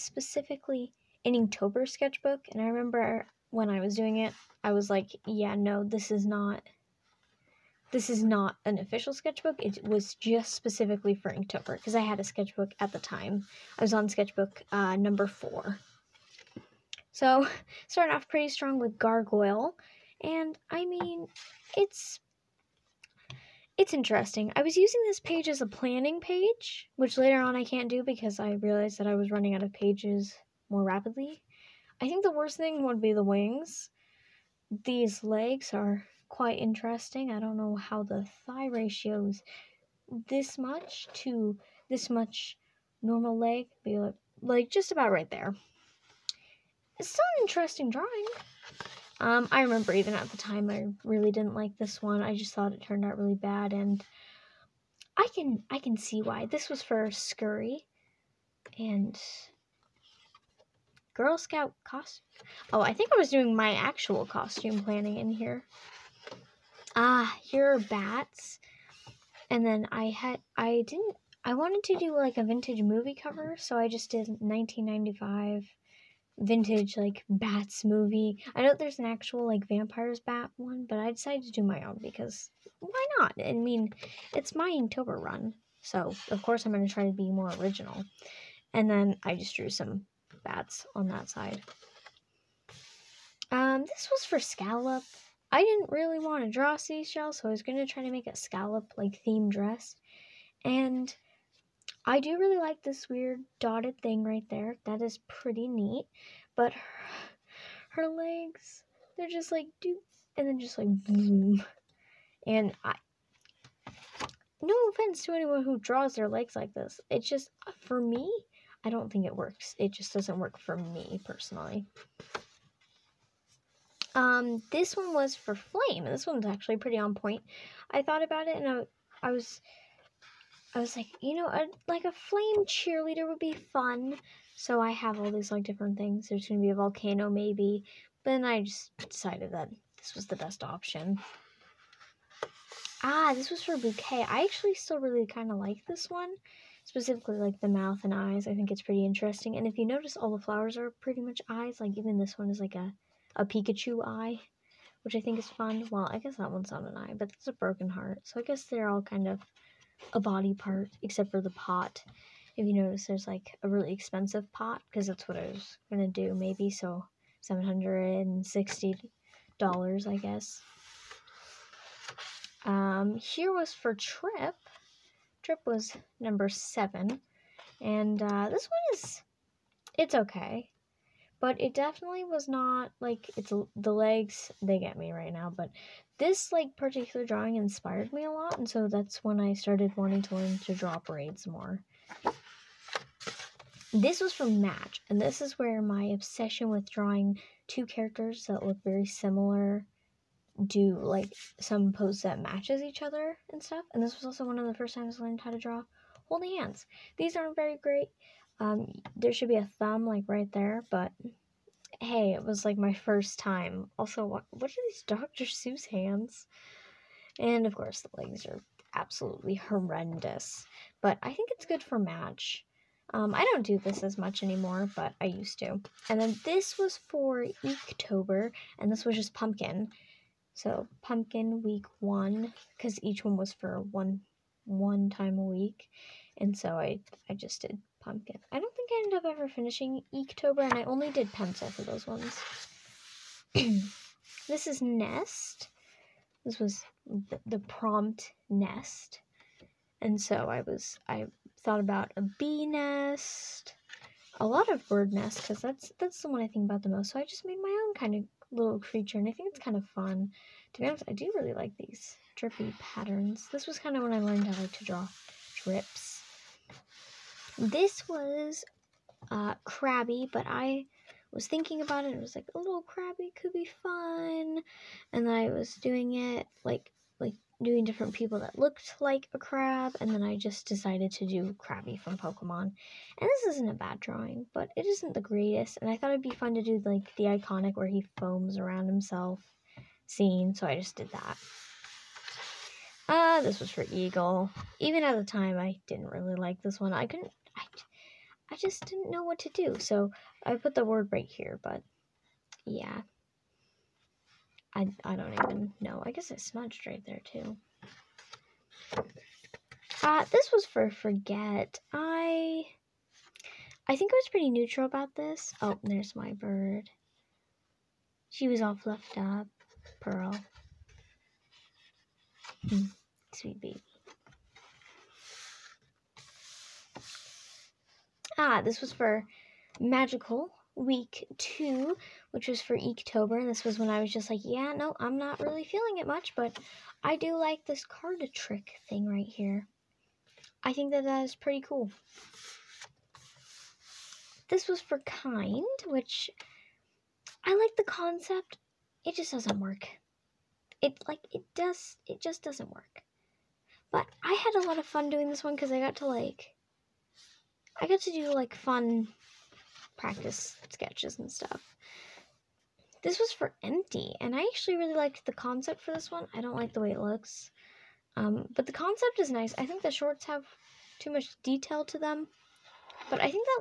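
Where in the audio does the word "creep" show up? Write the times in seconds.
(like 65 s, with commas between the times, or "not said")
not said.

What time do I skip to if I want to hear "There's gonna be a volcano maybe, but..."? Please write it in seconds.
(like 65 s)
136 s.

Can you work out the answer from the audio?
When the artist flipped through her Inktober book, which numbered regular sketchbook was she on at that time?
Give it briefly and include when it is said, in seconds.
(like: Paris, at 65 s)
4, at 14 s.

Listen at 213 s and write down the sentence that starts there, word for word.
Also, what, what are these Dr.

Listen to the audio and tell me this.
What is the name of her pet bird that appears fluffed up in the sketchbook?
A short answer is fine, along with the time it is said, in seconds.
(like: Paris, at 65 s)
Pearl, at 319 s.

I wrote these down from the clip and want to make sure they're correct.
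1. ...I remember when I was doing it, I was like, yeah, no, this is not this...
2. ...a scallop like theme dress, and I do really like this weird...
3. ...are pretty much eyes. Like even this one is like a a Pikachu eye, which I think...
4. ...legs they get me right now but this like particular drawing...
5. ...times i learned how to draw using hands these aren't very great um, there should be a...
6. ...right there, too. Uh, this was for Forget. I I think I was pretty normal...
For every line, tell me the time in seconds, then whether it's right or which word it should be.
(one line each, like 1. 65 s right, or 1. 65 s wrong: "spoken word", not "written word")
1. 2 s right
2. 98 s right
3. 150 s right
4. 183 s right
5. 204 s wrong: "holding", not "using"
6. 306 s wrong: "neutral", not "normal".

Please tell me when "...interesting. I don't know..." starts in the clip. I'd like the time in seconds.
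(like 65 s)
36 s.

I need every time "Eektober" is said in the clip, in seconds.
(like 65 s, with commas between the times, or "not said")
227 s, 240 s, 332 s.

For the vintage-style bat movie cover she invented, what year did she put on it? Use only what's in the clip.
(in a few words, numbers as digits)
1995.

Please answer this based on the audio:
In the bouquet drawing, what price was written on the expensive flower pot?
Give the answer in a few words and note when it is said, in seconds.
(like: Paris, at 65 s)
$760, at 167 s.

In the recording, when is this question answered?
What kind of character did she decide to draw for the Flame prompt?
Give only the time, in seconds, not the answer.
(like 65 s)
132 s.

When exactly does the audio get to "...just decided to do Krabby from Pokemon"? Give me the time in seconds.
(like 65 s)
280 s.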